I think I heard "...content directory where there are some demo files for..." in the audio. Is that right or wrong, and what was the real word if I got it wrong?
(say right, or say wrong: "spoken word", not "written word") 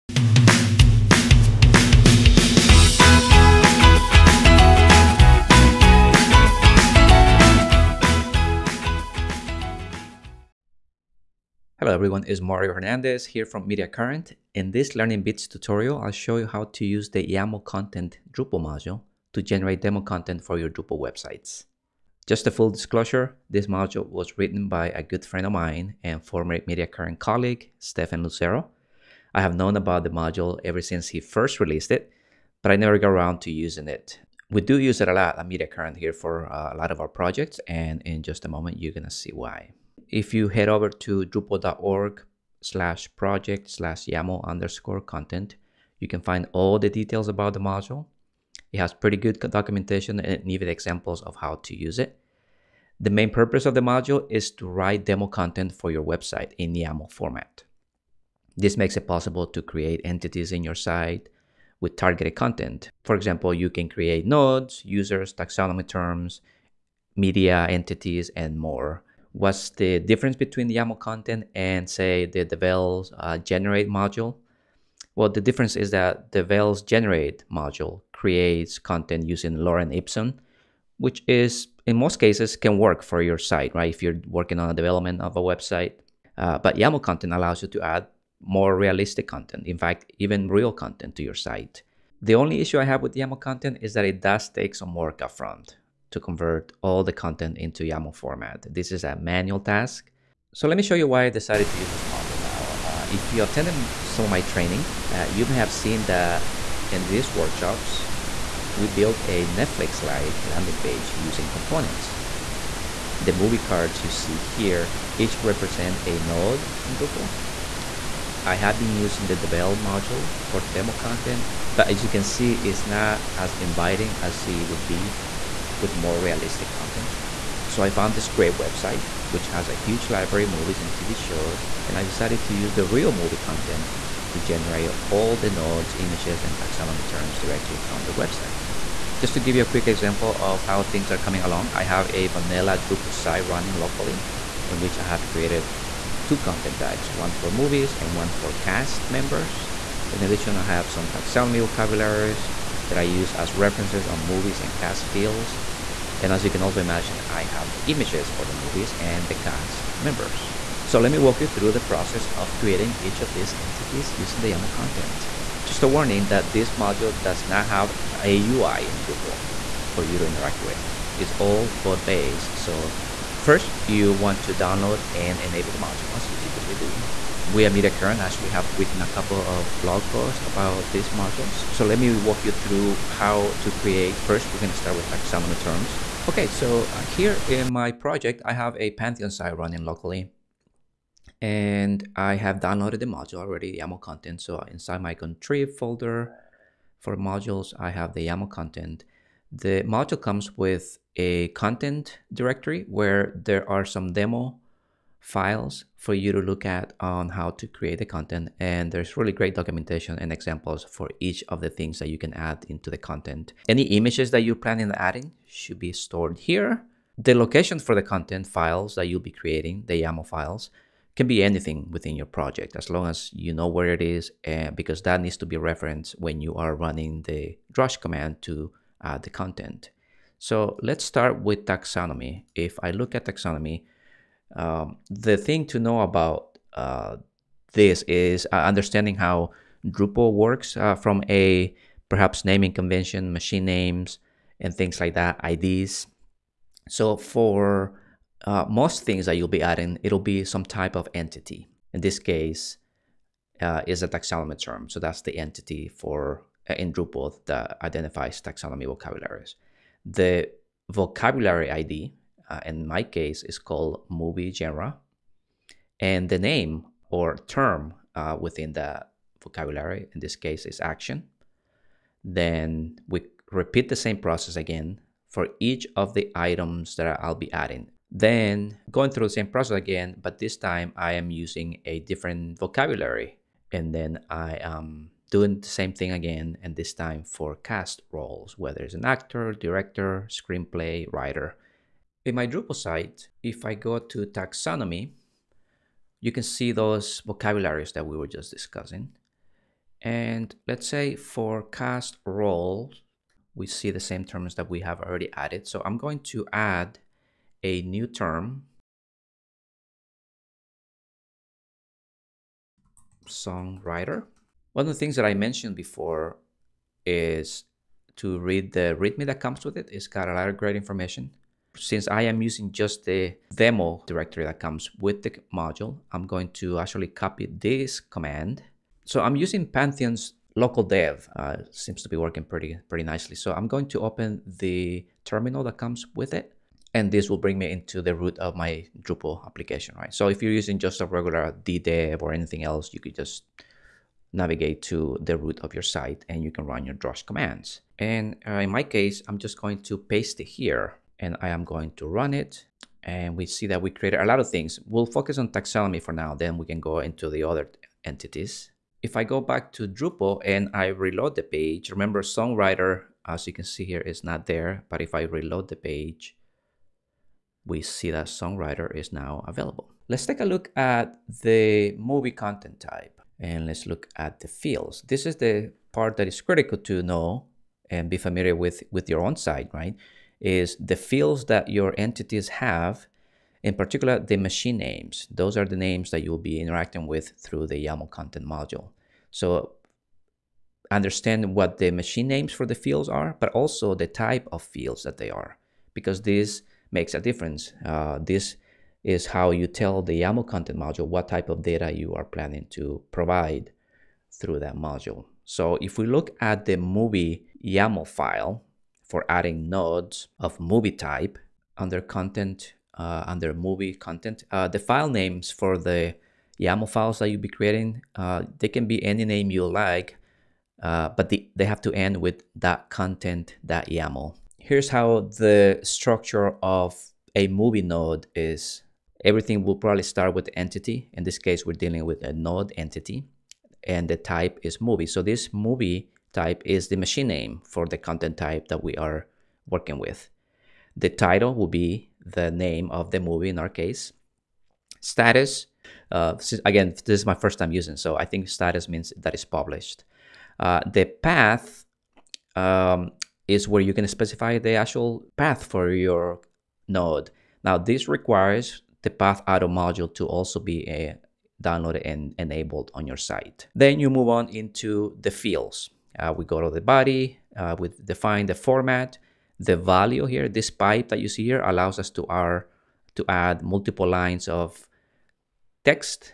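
right.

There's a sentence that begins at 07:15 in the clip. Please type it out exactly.
So this movie type is the machine name for the content type that we are working with.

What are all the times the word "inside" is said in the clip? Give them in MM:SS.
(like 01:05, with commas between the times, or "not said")
03:14.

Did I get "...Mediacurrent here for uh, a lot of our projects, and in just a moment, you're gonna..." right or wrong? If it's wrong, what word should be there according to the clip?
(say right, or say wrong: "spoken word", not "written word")
right.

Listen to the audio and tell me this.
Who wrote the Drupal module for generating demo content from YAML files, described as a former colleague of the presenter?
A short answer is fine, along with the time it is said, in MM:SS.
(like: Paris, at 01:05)
Stephen Lucero, at 00:27.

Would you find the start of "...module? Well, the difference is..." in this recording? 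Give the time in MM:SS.
01:13.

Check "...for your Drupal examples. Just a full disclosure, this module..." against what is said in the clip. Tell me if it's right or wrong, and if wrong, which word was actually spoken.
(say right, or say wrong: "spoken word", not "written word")
wrong: "websites", not "examples".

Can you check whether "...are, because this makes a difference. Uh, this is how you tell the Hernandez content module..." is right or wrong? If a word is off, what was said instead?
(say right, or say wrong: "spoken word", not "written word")
wrong: "YAML", not "Hernandez".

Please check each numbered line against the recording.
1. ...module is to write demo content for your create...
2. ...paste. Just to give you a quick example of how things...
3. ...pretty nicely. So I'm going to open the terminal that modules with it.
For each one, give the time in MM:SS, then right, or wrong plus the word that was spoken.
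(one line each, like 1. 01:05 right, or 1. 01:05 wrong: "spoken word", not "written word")
1. 00:53 wrong: "website", not "create"
2. 02:18 wrong: "website", not "paste"
3. 05:32 wrong: "comes", not "modules".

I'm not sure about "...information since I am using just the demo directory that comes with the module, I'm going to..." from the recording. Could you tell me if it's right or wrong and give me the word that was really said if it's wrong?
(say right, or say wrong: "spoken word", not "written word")
right.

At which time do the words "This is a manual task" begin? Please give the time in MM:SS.
01:38.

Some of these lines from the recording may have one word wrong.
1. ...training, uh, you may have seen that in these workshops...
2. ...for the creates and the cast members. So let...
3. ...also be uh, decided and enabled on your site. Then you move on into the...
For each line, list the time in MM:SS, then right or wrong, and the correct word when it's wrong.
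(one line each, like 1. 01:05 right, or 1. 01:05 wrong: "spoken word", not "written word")
1. 01:44 right
2. 02:38 wrong: "movies", not "creates"
3. 07:40 wrong: "downloaded", not "decided".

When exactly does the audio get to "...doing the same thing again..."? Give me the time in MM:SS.
04:45.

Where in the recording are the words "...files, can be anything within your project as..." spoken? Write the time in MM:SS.
03:40.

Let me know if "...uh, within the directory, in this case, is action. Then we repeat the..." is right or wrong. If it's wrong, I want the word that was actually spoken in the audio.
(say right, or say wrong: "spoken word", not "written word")
wrong: "vocabulary", not "directory".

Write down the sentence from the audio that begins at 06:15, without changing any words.
This is the part that is critical to know and be familiar with with your own site, right?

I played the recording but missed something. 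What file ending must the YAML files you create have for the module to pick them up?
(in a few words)
.content.yaml.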